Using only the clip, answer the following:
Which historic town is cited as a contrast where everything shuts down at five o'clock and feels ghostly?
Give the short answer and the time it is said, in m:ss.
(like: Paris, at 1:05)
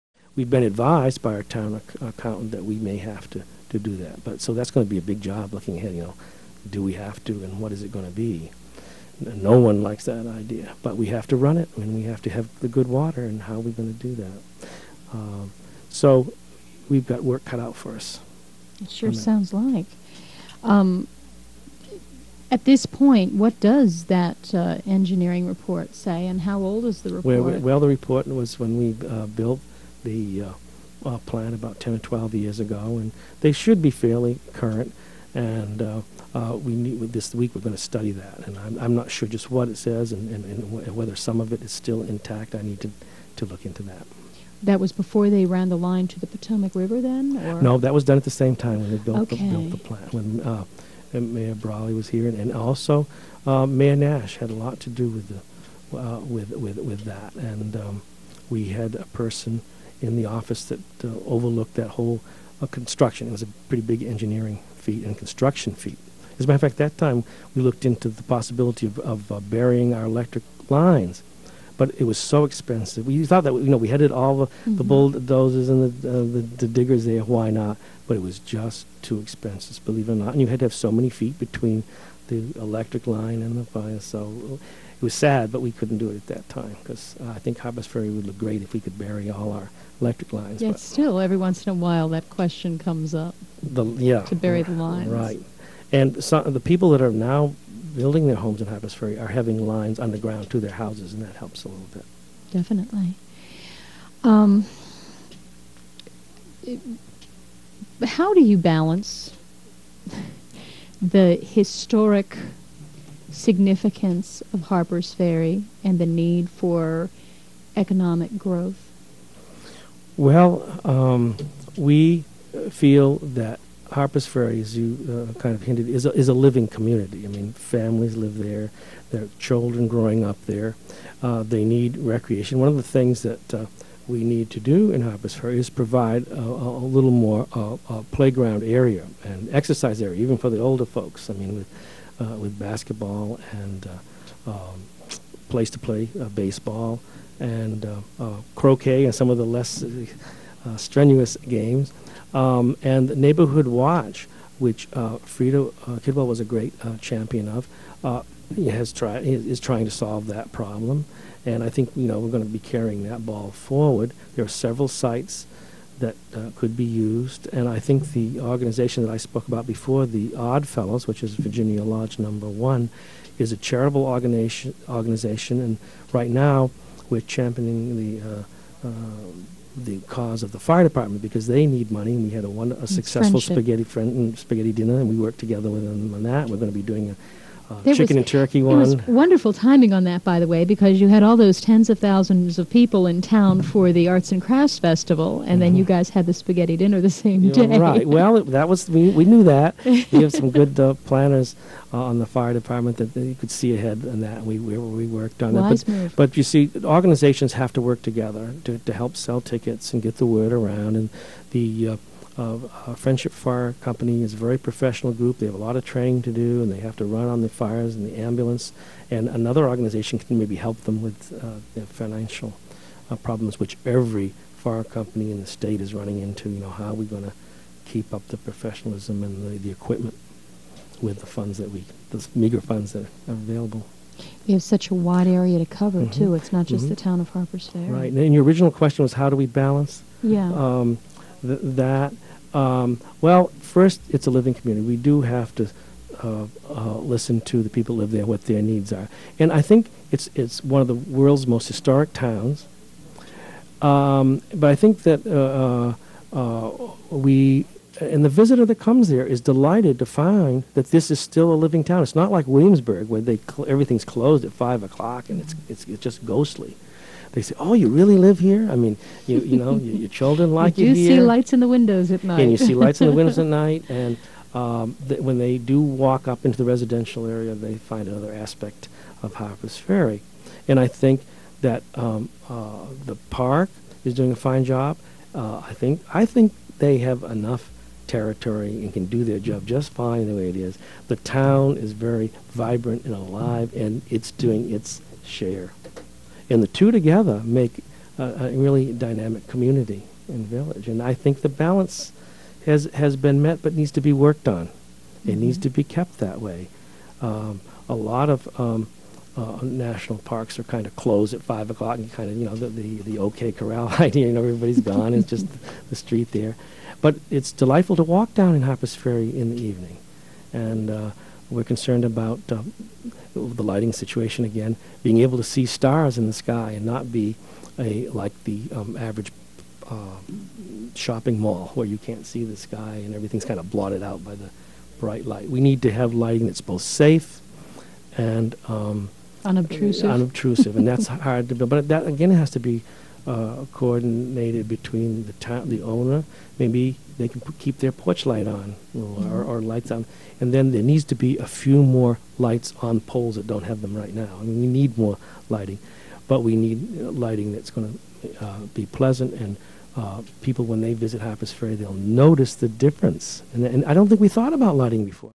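Williamsburg, at 4:22.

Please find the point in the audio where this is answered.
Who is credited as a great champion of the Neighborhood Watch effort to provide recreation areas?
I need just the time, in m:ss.
2:34.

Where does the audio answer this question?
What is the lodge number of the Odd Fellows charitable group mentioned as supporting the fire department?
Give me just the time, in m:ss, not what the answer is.
2:51.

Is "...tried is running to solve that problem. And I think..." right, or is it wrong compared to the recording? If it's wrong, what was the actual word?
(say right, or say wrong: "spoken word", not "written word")
wrong: "trying", not "running".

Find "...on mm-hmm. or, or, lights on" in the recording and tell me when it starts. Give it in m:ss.
5:48.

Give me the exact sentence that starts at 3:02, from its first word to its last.
And we had a, one, a successful friendship.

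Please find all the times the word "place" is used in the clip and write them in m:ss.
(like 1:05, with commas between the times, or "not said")
2:25.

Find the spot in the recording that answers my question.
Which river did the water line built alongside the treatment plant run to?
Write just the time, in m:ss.
0:46.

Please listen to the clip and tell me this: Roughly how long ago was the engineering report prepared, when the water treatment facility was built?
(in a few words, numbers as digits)
10 or 12 years.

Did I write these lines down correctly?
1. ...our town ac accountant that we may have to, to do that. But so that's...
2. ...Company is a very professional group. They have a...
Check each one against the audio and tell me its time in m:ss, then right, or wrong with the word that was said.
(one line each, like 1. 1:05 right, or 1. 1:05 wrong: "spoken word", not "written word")
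1. 0:01 right
2. 3:33 right.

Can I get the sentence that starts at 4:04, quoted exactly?
We do have to uh, uh, listen to the people who live there, what their needs are.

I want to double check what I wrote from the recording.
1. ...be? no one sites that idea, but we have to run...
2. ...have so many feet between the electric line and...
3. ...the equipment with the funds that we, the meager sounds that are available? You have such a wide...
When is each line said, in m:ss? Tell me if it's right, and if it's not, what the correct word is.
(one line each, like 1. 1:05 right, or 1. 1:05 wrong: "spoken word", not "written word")
1. 0:08 wrong: "likes", not "sites"
2. 1:20 right
3. 3:49 wrong: "funds", not "sounds".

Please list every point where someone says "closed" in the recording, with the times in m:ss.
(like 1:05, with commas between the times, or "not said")
4:24, 5:11.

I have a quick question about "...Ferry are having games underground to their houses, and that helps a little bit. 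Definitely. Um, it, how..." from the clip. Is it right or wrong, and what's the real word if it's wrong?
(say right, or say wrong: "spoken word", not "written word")
wrong: "lines", not "games".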